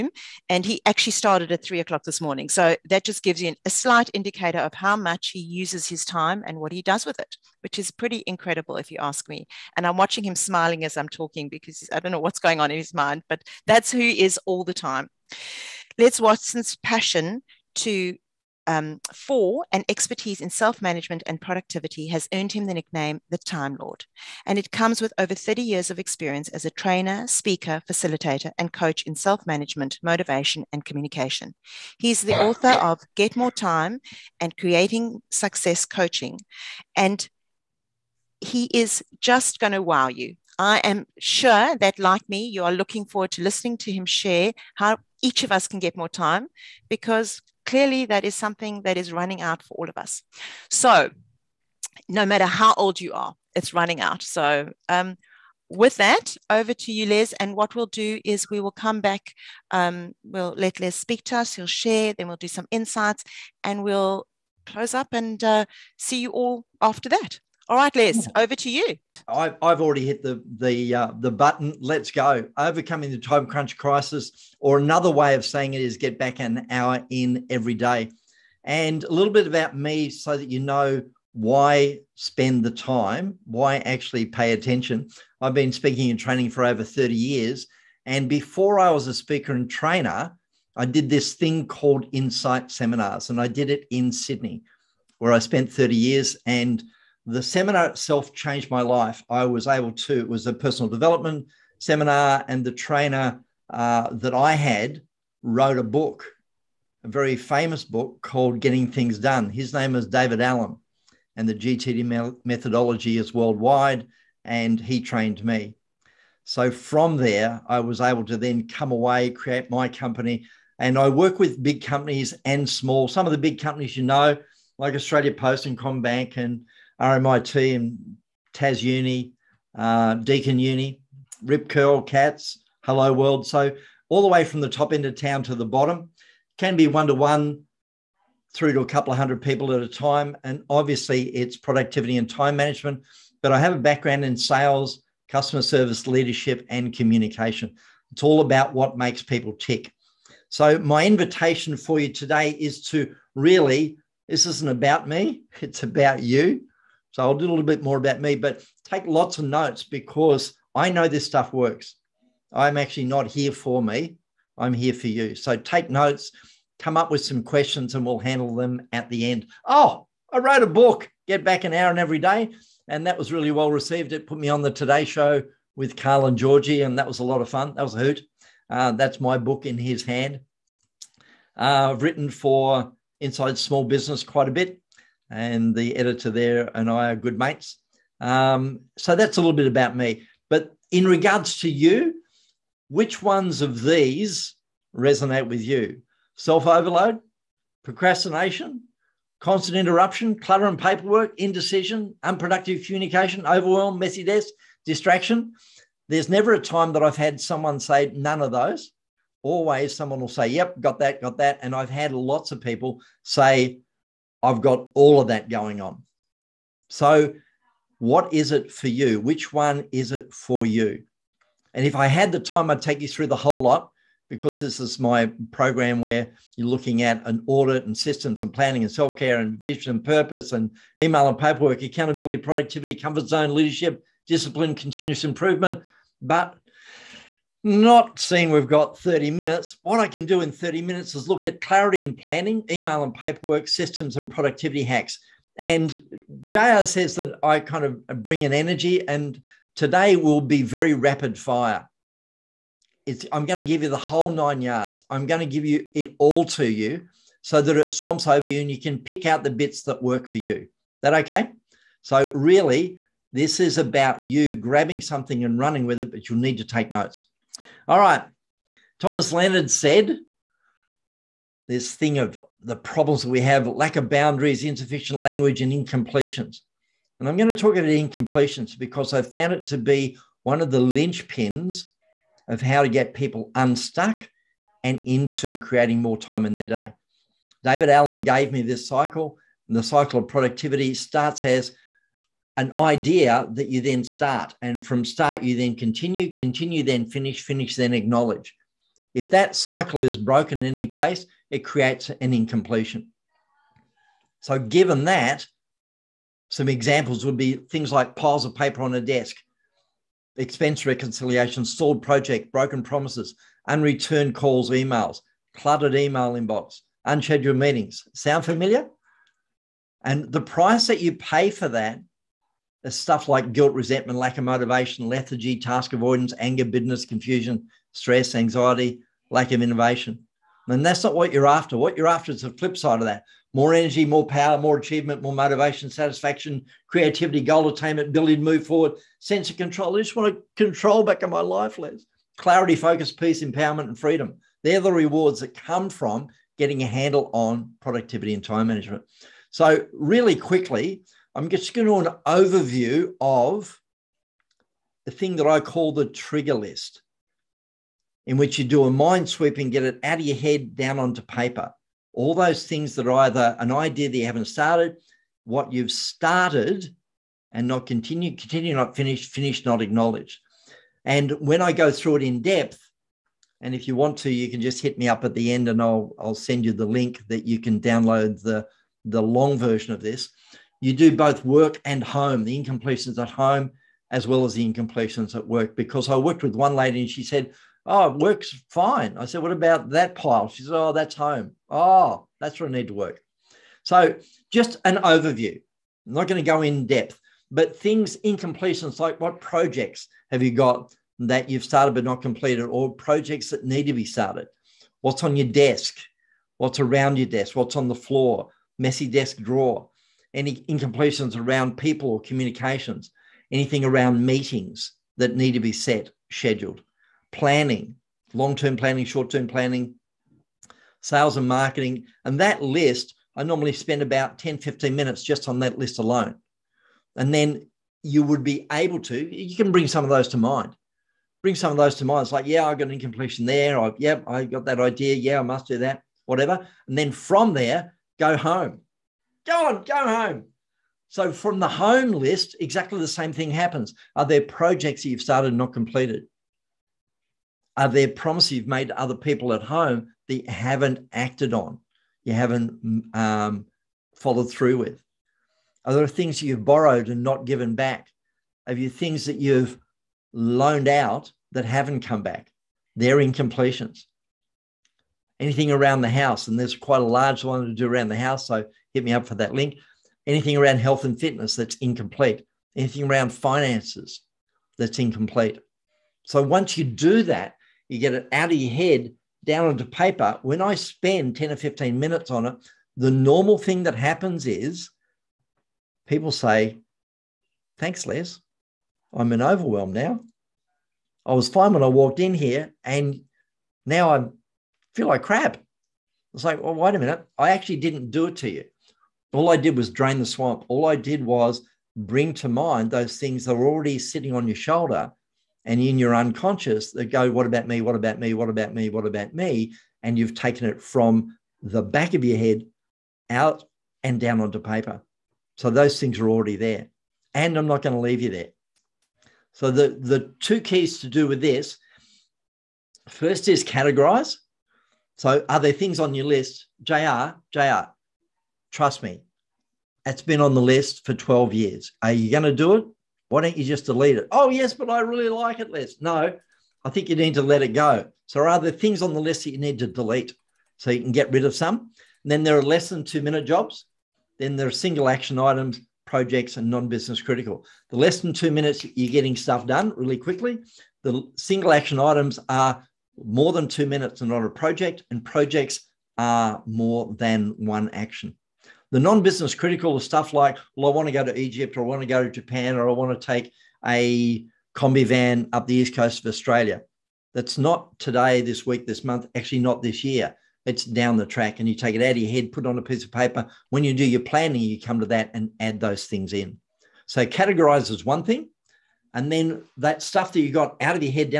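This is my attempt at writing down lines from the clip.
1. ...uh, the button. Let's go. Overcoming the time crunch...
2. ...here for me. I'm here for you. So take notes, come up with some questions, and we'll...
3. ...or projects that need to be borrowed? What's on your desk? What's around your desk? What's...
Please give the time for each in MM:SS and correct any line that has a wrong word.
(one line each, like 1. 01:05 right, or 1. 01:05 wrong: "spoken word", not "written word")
1. 01:10 right
2. 02:43 right
3. 06:42 wrong: "started", not "borrowed".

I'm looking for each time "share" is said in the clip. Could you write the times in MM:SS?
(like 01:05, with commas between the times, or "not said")
00:44, 01:01.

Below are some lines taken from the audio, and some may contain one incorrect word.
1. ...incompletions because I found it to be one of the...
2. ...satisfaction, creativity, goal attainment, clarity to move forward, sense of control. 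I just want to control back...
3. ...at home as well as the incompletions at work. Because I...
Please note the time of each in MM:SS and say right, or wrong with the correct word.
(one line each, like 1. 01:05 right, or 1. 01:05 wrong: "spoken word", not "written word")
1. 04:37 right
2. 05:35 wrong: "ability", not "clarity"
3. 06:23 right.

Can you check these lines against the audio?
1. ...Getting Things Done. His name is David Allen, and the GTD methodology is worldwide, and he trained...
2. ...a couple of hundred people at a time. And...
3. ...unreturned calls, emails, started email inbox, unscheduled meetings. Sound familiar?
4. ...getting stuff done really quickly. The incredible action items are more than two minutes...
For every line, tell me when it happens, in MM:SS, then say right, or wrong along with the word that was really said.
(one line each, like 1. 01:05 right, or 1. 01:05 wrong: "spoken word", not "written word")
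1. 01:48 right
2. 02:18 right
3. 05:13 wrong: "cluttered", not "started"
4. 09:09 wrong: "single", not "incredible".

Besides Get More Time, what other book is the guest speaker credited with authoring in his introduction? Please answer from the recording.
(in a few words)
Creating Success Coaching.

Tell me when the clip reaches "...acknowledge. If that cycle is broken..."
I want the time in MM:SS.
04:57.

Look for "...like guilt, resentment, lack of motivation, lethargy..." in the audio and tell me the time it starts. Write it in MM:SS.
05:23.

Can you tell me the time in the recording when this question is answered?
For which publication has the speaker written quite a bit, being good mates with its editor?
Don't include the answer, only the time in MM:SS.
03:03.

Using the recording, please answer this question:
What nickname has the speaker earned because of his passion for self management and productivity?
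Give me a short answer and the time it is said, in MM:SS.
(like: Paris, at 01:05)
the Time Lord, at 00:23.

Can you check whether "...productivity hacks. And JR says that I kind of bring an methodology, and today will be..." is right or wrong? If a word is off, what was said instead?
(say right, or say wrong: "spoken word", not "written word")
wrong: "energy", not "methodology".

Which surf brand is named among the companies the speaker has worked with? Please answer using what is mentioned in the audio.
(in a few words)
Rip Curl.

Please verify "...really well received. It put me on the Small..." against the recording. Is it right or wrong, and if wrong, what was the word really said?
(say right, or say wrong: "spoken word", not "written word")
wrong: "Today", not "Small".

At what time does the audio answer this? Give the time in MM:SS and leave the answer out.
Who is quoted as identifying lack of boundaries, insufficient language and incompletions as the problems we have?
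04:28.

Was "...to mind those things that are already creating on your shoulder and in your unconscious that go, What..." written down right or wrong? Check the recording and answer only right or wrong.
wrong.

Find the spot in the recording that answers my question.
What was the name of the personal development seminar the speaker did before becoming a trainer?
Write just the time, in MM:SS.
01:32.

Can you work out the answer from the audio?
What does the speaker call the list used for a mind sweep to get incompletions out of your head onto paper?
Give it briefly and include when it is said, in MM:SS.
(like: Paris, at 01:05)
the trigger list, at 05:55.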